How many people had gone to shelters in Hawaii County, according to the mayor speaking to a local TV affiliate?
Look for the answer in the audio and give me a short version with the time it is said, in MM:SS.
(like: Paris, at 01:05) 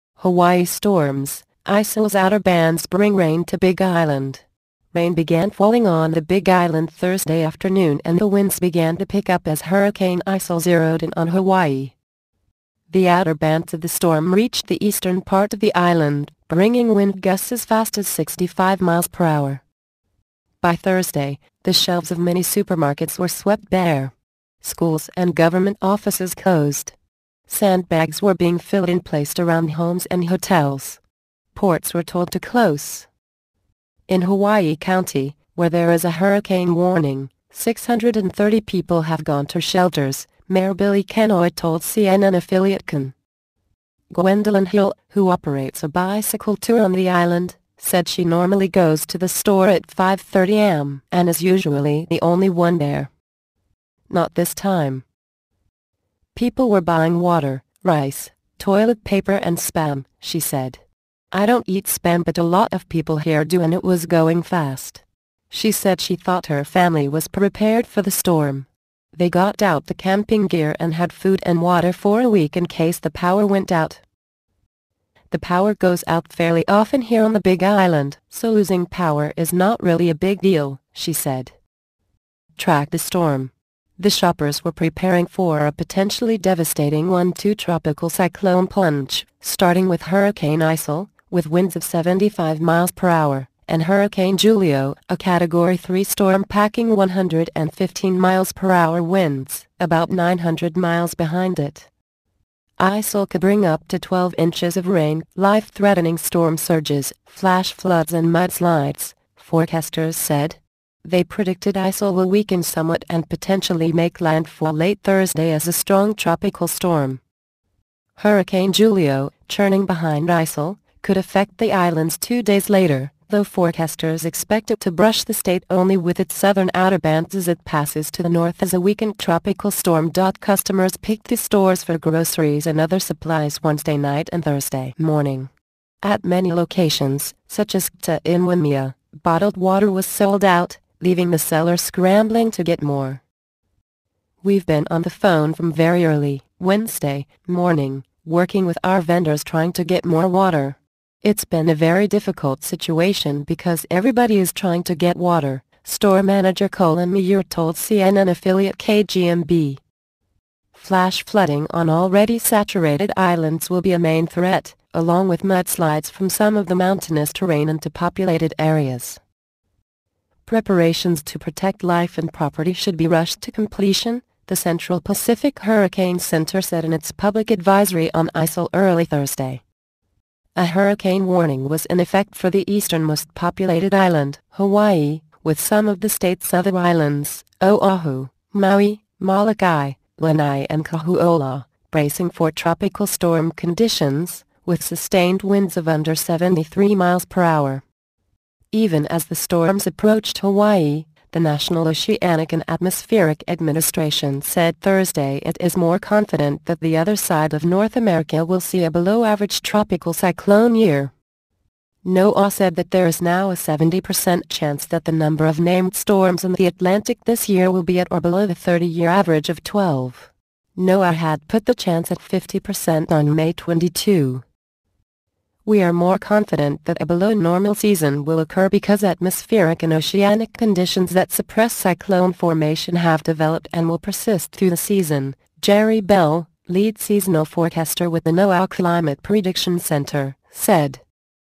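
630, at 00:37.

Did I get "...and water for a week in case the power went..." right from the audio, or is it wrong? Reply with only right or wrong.
right.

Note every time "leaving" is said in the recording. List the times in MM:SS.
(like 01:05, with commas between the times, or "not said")
02:21.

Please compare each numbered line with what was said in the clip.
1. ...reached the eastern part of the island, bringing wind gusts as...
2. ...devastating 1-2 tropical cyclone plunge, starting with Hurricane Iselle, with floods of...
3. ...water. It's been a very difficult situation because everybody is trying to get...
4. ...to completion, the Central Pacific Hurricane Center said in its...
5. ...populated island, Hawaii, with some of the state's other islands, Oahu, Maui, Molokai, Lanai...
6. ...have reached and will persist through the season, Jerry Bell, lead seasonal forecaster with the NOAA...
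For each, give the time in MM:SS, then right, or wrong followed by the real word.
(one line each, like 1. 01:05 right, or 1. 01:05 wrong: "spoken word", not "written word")
1. 00:14 right
2. 01:26 wrong: "winds", not "floods"
3. 02:30 right
4. 02:53 right
5. 03:03 right
6. 03:52 wrong: "developed", not "reached".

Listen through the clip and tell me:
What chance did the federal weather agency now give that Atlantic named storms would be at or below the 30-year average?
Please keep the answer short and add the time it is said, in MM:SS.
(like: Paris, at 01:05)
70%, at 03:33.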